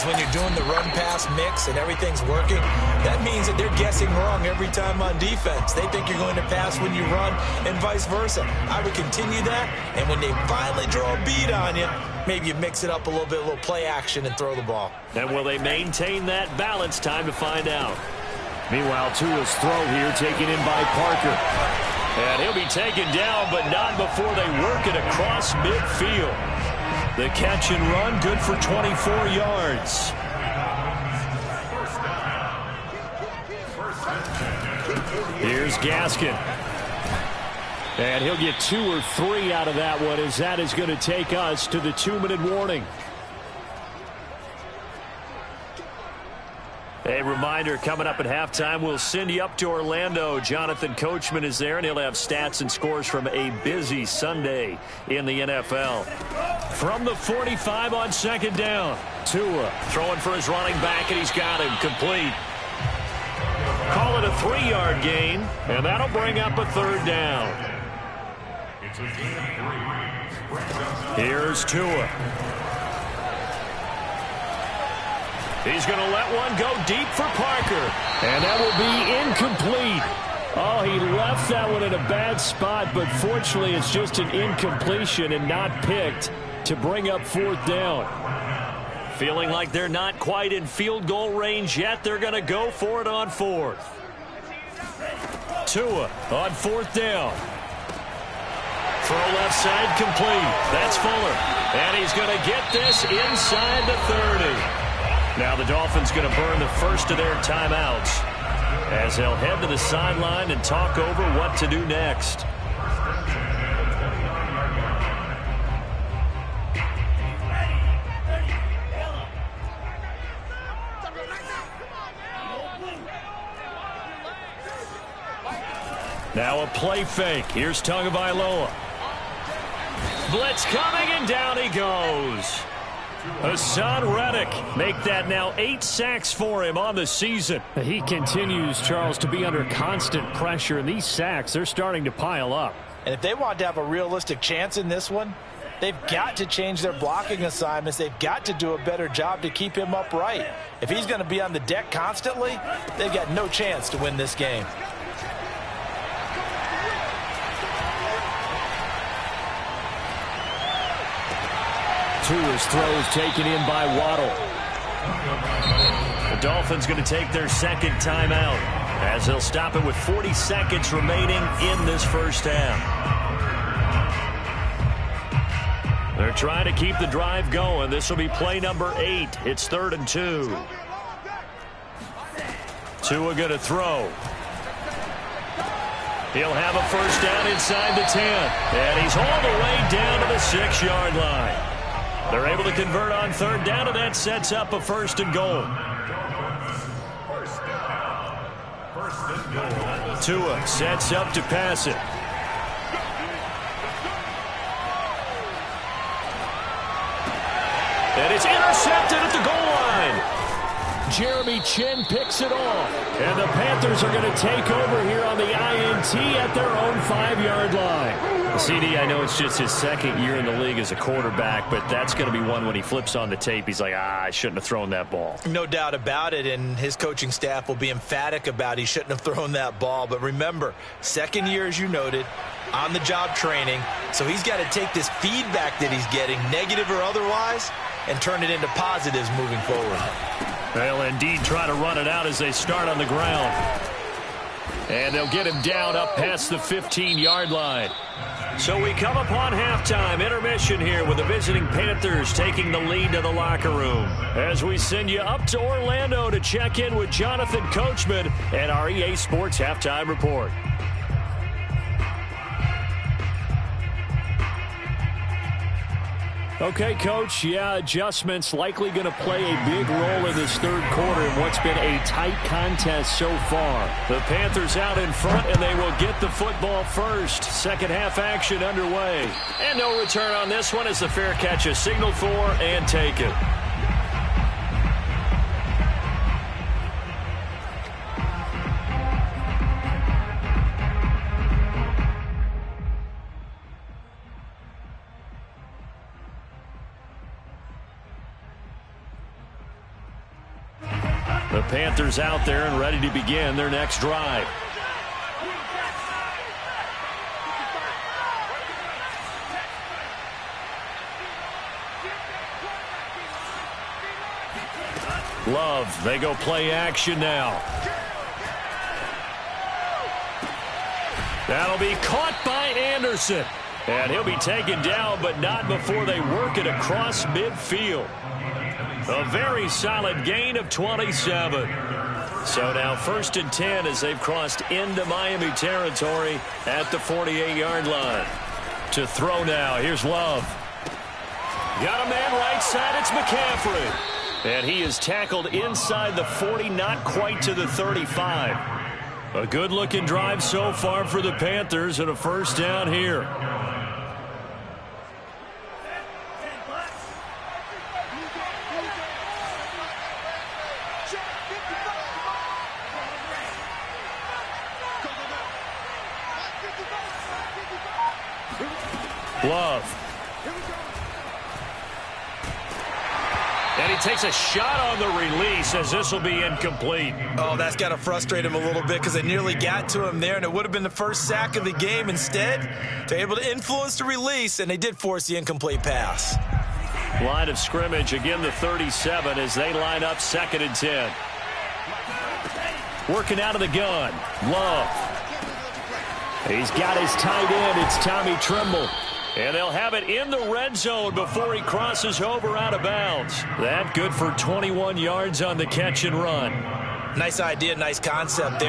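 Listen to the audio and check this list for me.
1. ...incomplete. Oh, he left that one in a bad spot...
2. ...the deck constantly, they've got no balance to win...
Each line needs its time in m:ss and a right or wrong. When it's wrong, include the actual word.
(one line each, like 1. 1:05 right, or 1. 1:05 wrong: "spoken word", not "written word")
1. 1:19 right
2. 2:31 wrong: "chance", not "balance".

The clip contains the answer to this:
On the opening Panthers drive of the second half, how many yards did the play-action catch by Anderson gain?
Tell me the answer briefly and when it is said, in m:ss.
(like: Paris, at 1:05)
27, at 5:30.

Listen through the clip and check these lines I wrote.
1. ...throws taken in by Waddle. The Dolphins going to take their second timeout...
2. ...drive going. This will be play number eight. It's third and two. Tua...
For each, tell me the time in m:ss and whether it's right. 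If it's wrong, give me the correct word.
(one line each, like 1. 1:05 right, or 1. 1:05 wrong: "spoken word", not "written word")
1. 2:42 right
2. 2:57 right.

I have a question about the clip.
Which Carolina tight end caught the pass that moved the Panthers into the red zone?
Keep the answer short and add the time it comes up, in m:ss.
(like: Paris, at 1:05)
Tommy Tremble, at 6:37.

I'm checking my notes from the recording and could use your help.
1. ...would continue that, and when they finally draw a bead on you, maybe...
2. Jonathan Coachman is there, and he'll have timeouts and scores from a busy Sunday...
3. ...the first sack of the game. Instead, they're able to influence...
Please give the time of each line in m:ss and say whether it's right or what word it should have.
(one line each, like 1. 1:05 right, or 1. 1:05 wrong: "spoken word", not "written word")
1. 0:08 right
2. 0:50 wrong: "stats", not "timeouts"
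3. 6:20 right.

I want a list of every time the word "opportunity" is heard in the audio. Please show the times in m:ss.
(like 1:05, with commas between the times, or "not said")
not said.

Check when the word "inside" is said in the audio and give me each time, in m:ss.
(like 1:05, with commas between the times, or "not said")
1:43, 3:07, 5:45.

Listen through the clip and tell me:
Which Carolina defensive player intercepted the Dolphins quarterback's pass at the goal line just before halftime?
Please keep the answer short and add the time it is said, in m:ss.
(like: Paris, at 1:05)
Jeremy Chinn, at 3:31.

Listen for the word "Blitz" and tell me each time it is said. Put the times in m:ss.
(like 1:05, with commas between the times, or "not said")
2:10.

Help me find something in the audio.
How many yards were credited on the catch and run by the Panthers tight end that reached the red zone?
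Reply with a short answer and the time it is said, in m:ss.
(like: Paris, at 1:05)
21, at 6:44.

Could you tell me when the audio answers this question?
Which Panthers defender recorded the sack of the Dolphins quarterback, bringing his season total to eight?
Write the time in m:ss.
2:13.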